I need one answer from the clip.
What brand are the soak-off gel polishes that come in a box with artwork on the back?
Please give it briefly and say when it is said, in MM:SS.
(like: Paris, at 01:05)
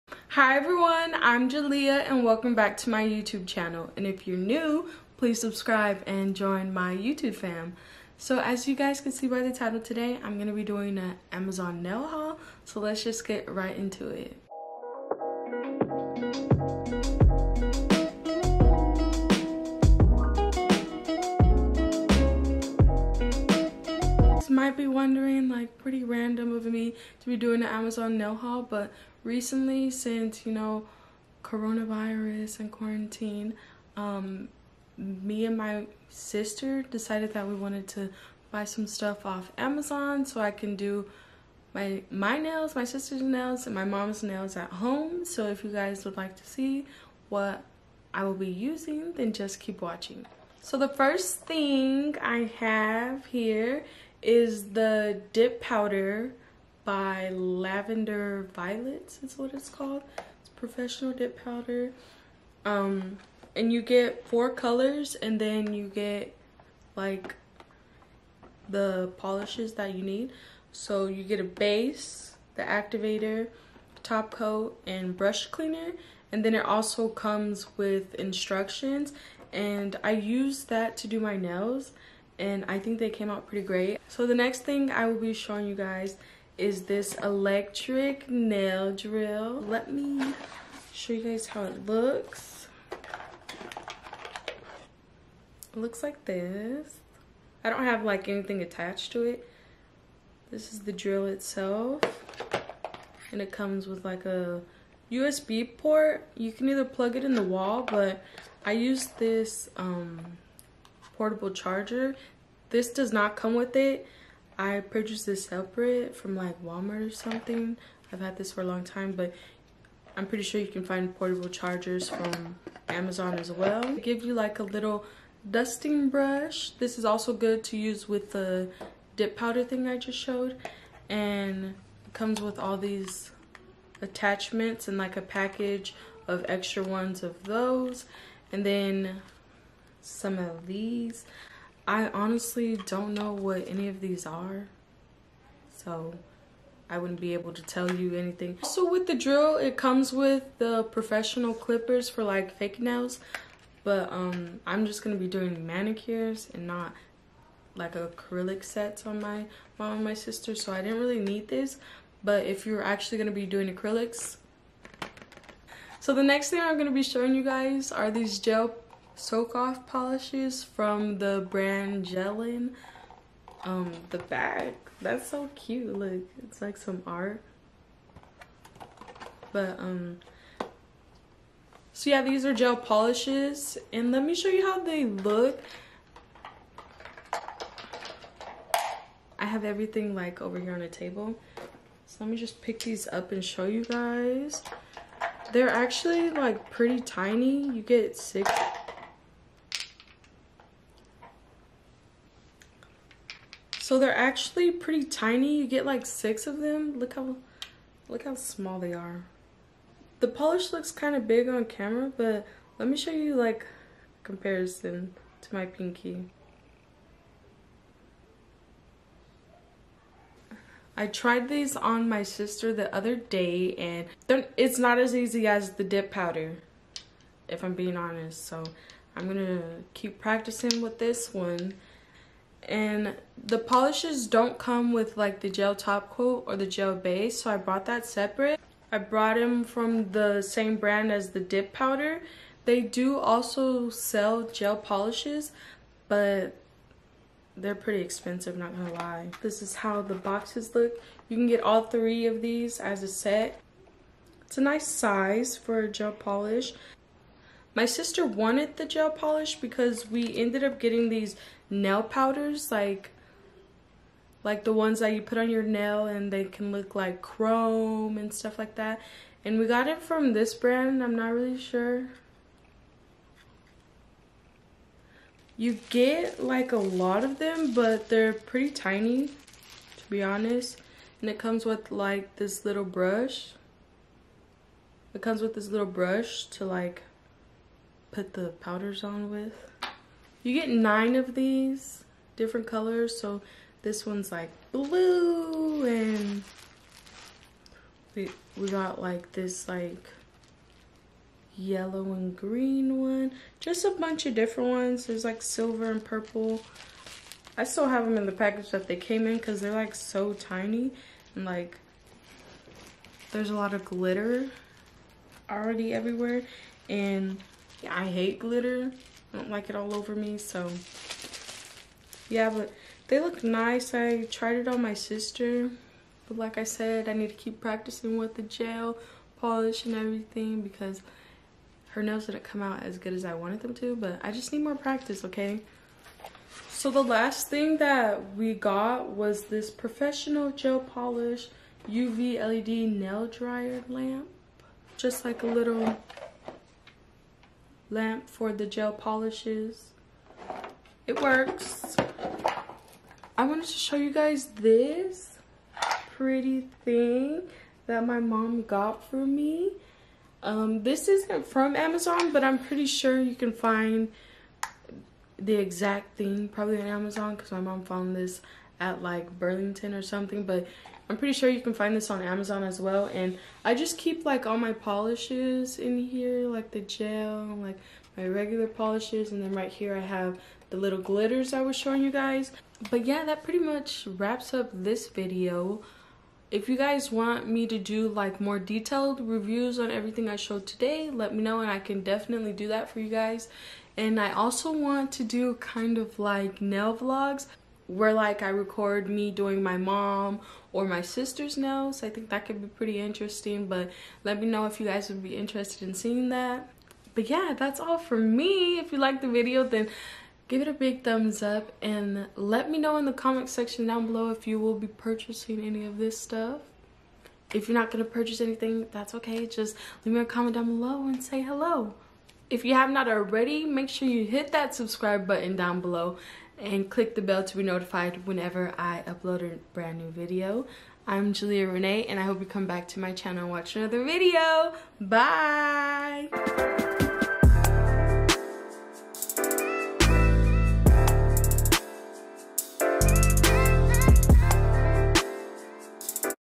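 Gelin, at 02:52.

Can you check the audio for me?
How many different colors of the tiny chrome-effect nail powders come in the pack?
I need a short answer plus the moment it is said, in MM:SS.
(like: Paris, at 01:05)
9, at 04:50.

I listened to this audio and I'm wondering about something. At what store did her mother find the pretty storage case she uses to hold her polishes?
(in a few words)
Burlington.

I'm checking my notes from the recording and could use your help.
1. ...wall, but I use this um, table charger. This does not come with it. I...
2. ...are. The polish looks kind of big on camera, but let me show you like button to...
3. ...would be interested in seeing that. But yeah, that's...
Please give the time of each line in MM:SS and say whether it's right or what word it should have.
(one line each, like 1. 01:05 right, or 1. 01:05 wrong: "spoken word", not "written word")
1. 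01:47 wrong: "portable", not "table"
2. 03:28 wrong: "comparison", not "button"
3. 06:45 right.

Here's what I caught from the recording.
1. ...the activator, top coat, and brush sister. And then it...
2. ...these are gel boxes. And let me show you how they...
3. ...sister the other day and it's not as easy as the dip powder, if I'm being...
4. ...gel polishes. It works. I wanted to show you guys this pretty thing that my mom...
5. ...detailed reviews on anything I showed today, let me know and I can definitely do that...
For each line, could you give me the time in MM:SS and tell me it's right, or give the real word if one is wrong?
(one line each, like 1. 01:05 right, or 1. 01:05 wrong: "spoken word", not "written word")
1. 01:12 wrong: "cleaner", not "sister"
2. 03:02 wrong: "polishes", not "boxes"
3. 03:42 right
4. 05:48 right
5. 06:28 wrong: "everything", not "anything".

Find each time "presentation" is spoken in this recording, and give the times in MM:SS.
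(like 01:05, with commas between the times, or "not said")
not said.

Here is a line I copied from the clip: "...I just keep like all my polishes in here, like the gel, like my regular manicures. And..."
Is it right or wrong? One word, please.
wrong.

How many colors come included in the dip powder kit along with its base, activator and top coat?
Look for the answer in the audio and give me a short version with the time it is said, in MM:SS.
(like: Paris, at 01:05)
4, at 01:04.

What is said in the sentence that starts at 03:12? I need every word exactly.
So let me just pick these up and show you guys.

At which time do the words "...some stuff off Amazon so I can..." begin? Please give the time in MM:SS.
00:38.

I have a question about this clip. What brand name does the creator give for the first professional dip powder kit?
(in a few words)
Lavender Violets.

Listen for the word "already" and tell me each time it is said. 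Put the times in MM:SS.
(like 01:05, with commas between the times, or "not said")
05:15, 07:03.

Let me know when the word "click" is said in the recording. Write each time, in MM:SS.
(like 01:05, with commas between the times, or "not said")
07:06.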